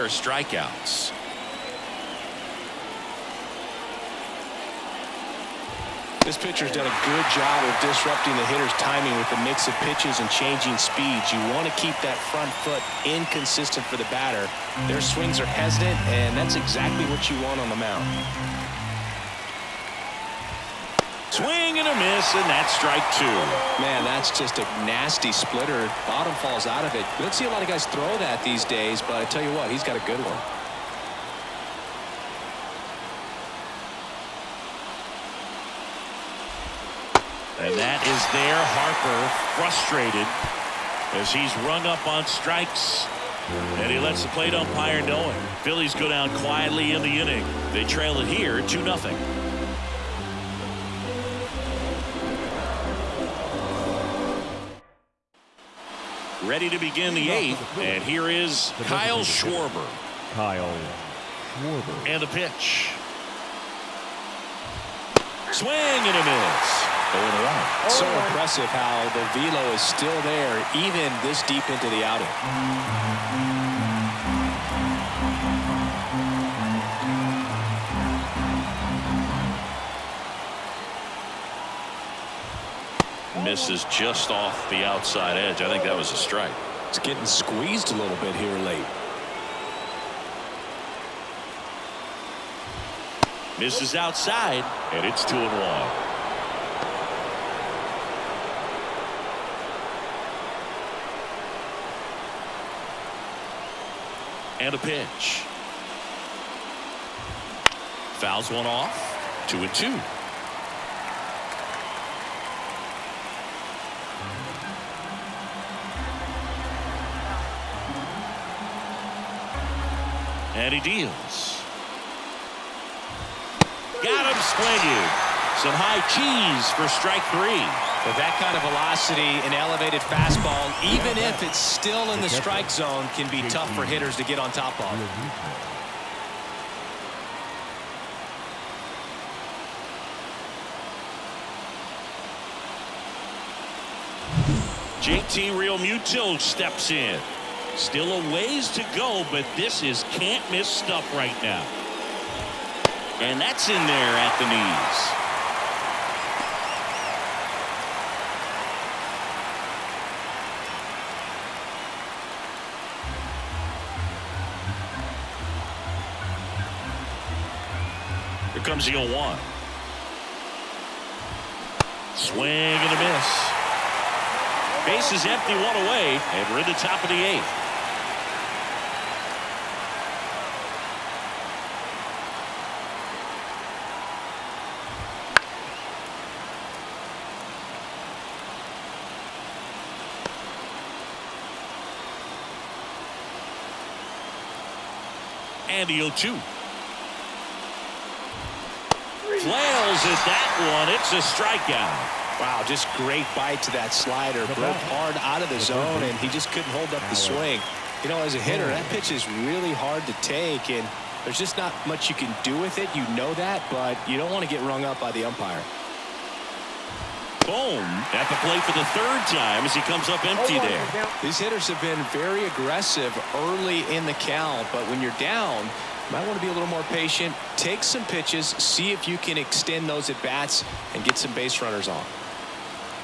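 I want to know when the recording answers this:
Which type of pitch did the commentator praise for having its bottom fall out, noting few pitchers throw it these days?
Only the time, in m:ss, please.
0:25.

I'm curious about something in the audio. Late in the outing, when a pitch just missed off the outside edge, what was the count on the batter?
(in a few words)
2 and 1.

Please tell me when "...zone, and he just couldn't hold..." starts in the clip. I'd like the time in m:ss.
3:25.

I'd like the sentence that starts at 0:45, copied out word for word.
Phillies go down quietly in the inning.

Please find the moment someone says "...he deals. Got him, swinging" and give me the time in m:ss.
2:00.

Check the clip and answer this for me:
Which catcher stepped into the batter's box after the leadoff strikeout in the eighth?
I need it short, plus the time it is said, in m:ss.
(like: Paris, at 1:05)
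JT Realmuto, at 2:25.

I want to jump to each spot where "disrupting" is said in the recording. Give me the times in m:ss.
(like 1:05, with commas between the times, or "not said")
0:07.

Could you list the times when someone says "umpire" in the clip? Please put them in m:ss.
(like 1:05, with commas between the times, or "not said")
0:44, 3:35.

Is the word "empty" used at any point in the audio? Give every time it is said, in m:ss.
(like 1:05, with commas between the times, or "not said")
2:55, 3:40.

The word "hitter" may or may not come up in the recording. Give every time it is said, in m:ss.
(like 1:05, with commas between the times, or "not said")
0:08, 2:13, 3:28, 3:41.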